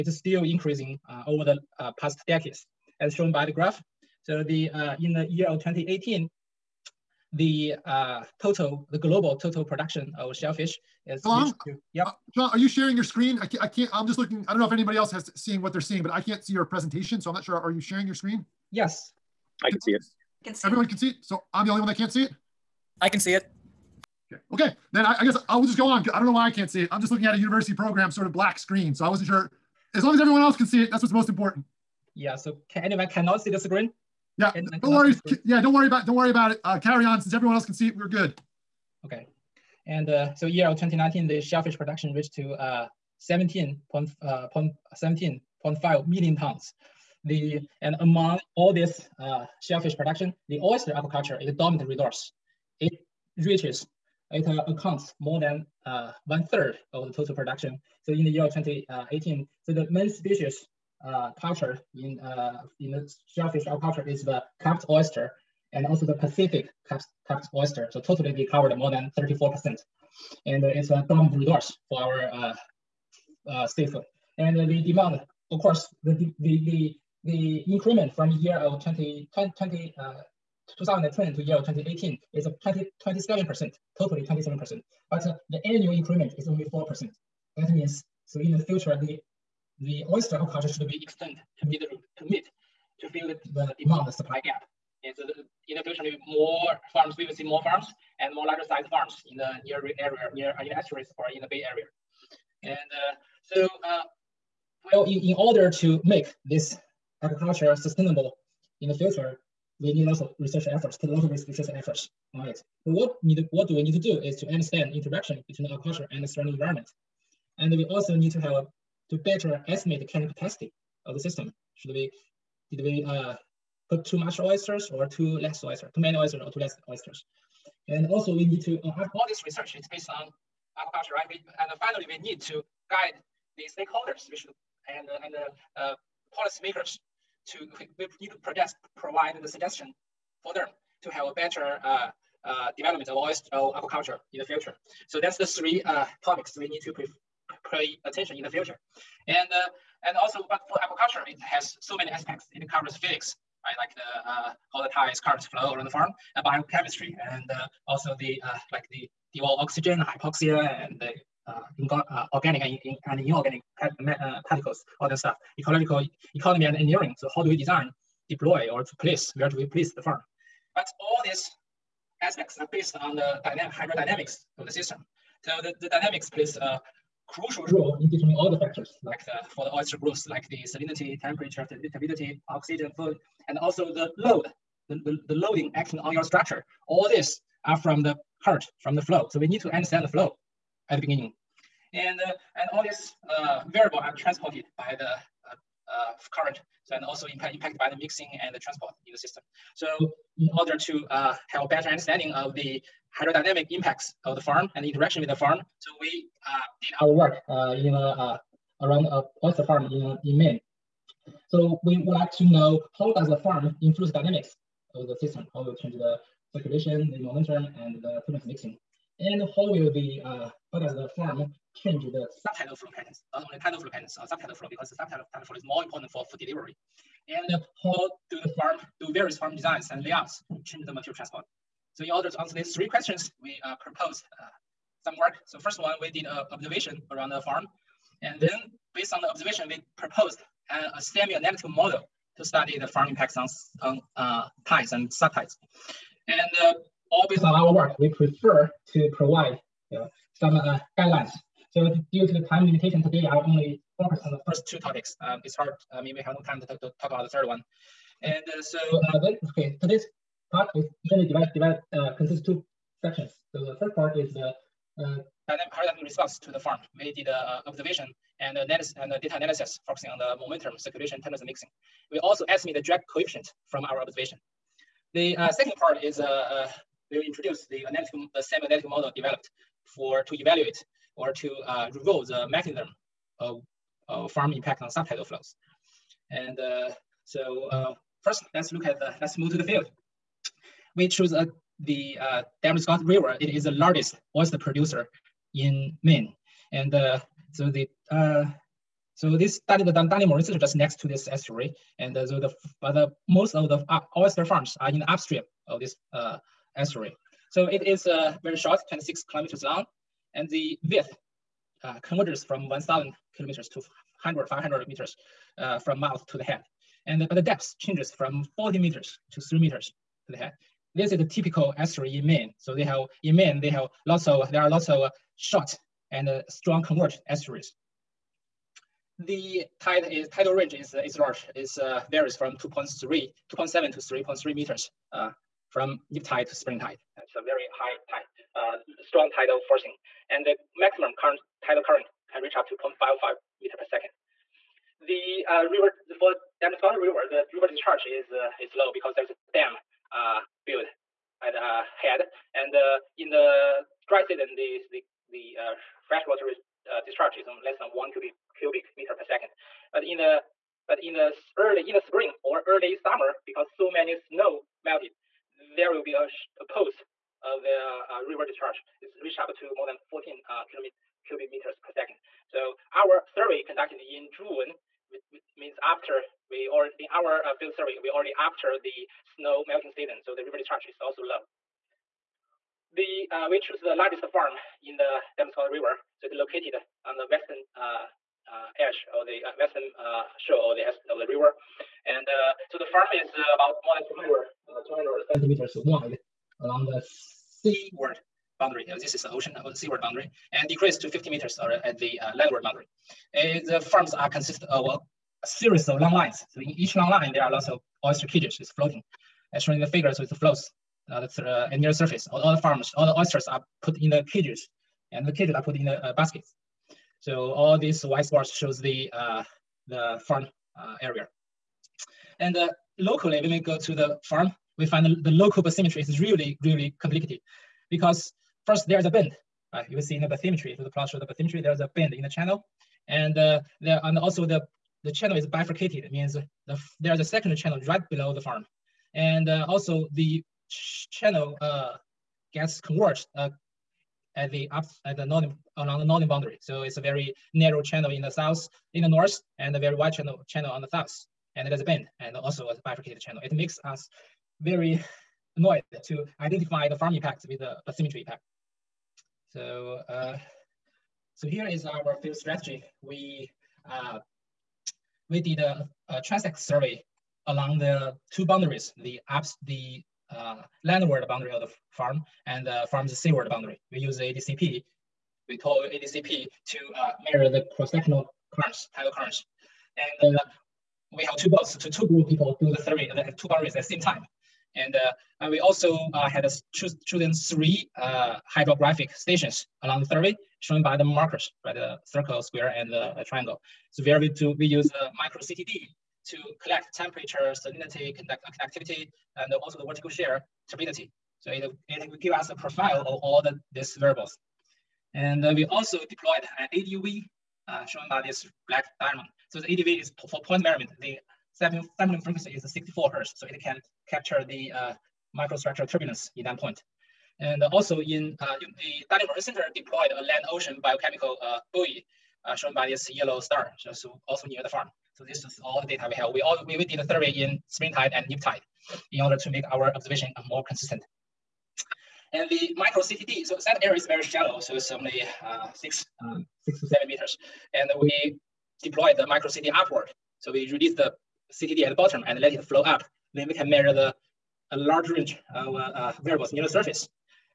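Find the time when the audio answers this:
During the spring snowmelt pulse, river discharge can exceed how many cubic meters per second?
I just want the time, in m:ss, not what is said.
6:10.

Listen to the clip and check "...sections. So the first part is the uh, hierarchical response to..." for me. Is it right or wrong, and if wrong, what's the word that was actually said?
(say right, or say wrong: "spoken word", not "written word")
right.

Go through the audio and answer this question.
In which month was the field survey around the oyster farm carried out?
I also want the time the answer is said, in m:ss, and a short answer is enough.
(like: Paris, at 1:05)
June, at 6:14.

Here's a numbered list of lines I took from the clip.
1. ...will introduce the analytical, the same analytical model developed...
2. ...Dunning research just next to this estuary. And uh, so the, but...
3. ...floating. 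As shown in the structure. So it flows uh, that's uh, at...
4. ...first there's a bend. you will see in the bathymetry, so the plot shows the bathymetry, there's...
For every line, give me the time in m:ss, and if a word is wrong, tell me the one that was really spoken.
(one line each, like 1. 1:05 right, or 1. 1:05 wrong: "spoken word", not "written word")
1. 4:37 right
2. 4:59 right
3. 6:48 wrong: "figure", not "structure"
4. 7:08 right.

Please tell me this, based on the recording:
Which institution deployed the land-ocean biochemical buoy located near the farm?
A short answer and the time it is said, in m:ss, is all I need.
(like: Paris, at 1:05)
Darling Marine Center, at 8:39.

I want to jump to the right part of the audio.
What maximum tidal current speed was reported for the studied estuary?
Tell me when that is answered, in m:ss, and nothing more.
5:42.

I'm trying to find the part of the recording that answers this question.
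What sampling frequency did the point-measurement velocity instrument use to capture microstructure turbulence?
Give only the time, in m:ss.
8:32.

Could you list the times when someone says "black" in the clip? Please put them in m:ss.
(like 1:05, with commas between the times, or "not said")
0:28, 8:28.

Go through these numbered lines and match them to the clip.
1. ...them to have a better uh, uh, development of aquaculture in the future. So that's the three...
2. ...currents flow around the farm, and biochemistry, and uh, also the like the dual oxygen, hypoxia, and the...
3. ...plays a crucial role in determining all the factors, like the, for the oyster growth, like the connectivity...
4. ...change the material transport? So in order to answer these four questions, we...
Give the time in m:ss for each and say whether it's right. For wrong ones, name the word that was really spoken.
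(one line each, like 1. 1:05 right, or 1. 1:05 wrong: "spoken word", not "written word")
1. 2:20 right
2. 2:35 right
3. 2:56 wrong: "salinity", not "connectivity"
4. 3:50 wrong: "three", not "four".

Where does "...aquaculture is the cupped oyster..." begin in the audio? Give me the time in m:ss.
1:03.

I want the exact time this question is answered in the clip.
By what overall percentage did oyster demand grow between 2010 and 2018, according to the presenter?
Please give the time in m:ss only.
1:23.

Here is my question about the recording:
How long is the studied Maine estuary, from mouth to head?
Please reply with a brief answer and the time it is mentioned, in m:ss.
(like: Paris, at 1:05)
26 kilometers, at 5:08.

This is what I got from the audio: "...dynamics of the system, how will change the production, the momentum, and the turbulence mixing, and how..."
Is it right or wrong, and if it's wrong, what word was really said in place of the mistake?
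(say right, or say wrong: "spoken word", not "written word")
wrong: "circulation", not "production".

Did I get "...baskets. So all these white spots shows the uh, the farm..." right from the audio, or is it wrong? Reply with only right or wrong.
right.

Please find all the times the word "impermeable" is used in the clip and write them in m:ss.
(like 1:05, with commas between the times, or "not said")
not said.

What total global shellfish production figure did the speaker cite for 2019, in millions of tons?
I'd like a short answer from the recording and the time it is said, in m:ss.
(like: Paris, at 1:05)
17.5 million tons, at 0:44.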